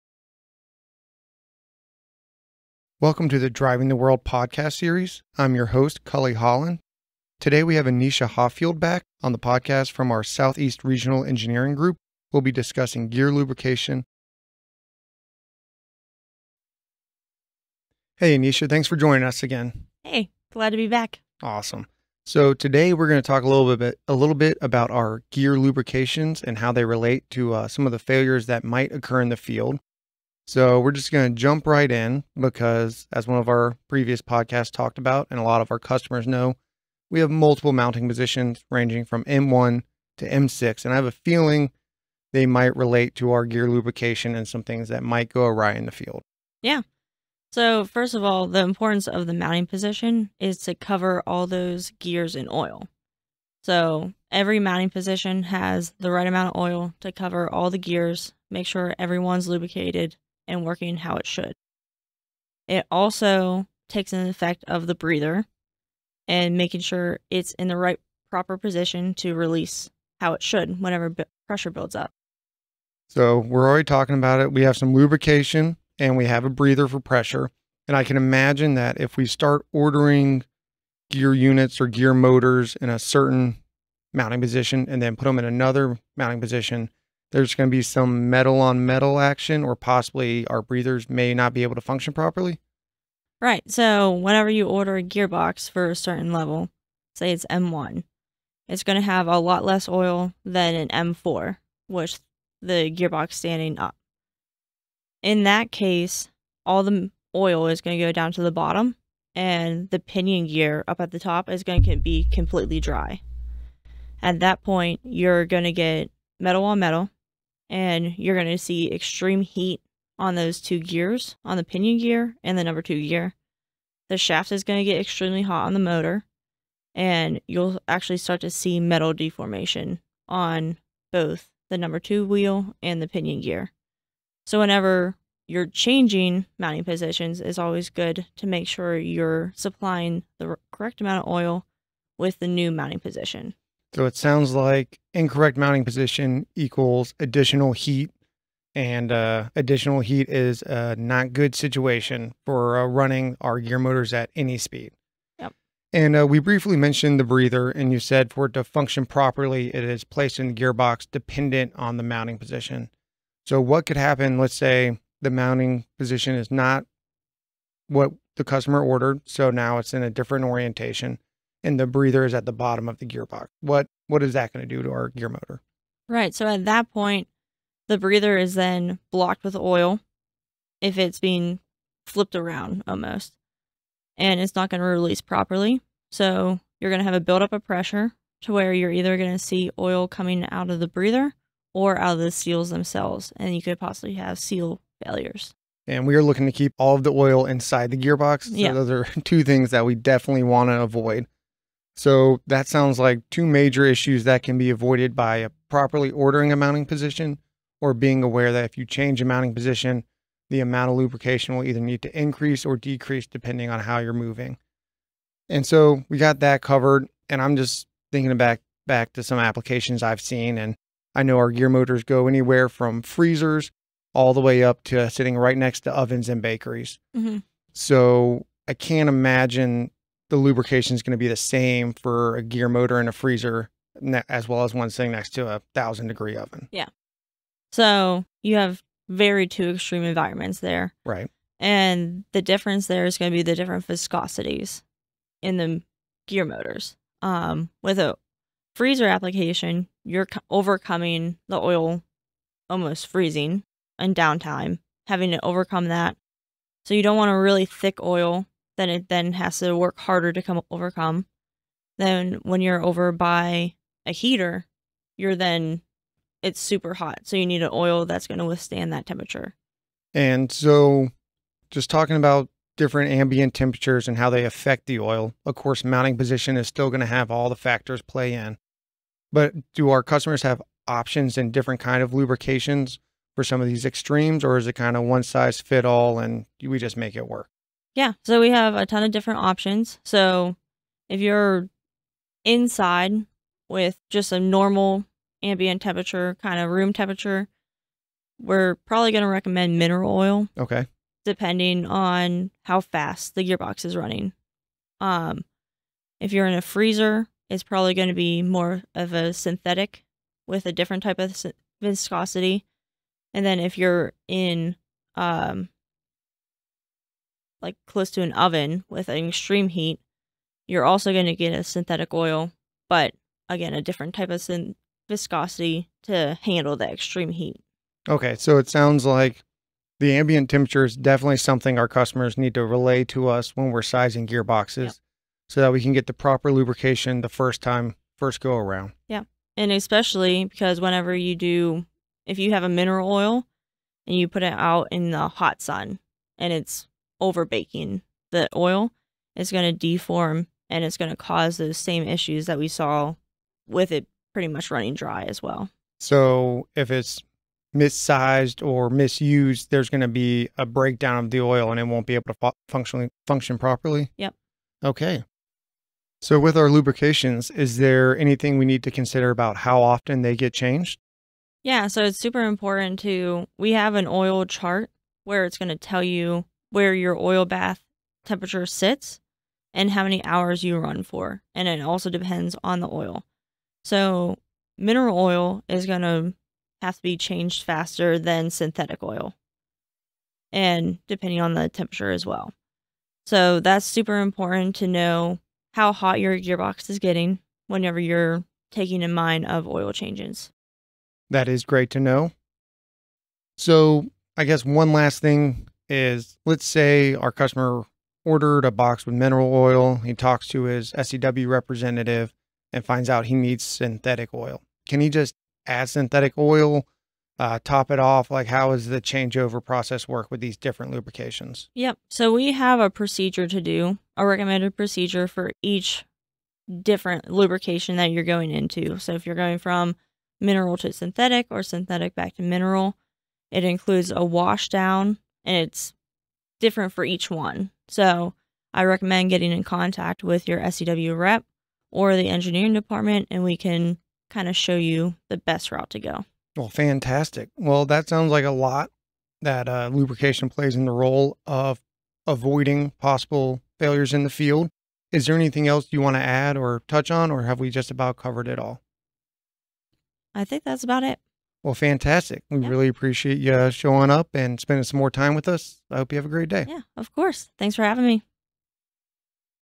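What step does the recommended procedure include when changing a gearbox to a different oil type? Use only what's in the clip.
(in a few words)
a wash down.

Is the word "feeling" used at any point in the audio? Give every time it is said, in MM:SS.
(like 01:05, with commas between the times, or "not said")
00:41.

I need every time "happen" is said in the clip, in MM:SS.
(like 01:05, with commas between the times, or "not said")
02:43.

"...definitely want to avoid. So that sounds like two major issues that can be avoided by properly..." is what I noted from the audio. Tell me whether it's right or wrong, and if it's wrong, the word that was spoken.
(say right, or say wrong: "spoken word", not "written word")
right.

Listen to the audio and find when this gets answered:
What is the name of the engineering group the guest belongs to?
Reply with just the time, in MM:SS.
00:10.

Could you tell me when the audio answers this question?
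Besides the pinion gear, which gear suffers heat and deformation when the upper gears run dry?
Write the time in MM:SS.
02:02.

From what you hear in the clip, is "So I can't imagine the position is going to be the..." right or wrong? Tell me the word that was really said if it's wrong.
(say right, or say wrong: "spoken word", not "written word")
wrong: "lubrication", not "position".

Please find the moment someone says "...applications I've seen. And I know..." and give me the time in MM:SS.
03:39.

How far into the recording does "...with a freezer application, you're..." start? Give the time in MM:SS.
04:07.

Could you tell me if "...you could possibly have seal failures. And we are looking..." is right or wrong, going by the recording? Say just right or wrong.
right.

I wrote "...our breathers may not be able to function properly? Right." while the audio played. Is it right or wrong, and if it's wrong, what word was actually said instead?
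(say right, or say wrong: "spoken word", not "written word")
right.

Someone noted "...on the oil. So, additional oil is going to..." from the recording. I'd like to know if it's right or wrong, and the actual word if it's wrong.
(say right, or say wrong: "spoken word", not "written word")
wrong: "mineral", not "additional".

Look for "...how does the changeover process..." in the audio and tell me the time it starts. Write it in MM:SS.
06:58.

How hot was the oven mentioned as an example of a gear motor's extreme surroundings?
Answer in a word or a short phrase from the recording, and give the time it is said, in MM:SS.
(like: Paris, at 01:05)
1000 degrees, at 03:55.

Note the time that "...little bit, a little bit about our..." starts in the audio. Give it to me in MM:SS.
00:23.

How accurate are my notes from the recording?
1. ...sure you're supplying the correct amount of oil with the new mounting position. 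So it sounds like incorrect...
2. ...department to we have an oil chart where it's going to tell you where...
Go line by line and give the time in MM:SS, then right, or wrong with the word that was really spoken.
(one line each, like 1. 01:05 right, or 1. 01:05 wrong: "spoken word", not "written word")
1. 02:18 right
2. 06:12 wrong: "important", not "department".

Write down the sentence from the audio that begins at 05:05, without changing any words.
Um, if you're in a freezer, it's probably going to be more of a synthetic with a different type of viscosity.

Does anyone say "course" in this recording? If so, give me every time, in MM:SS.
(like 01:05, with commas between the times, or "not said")
04:35, 07:47.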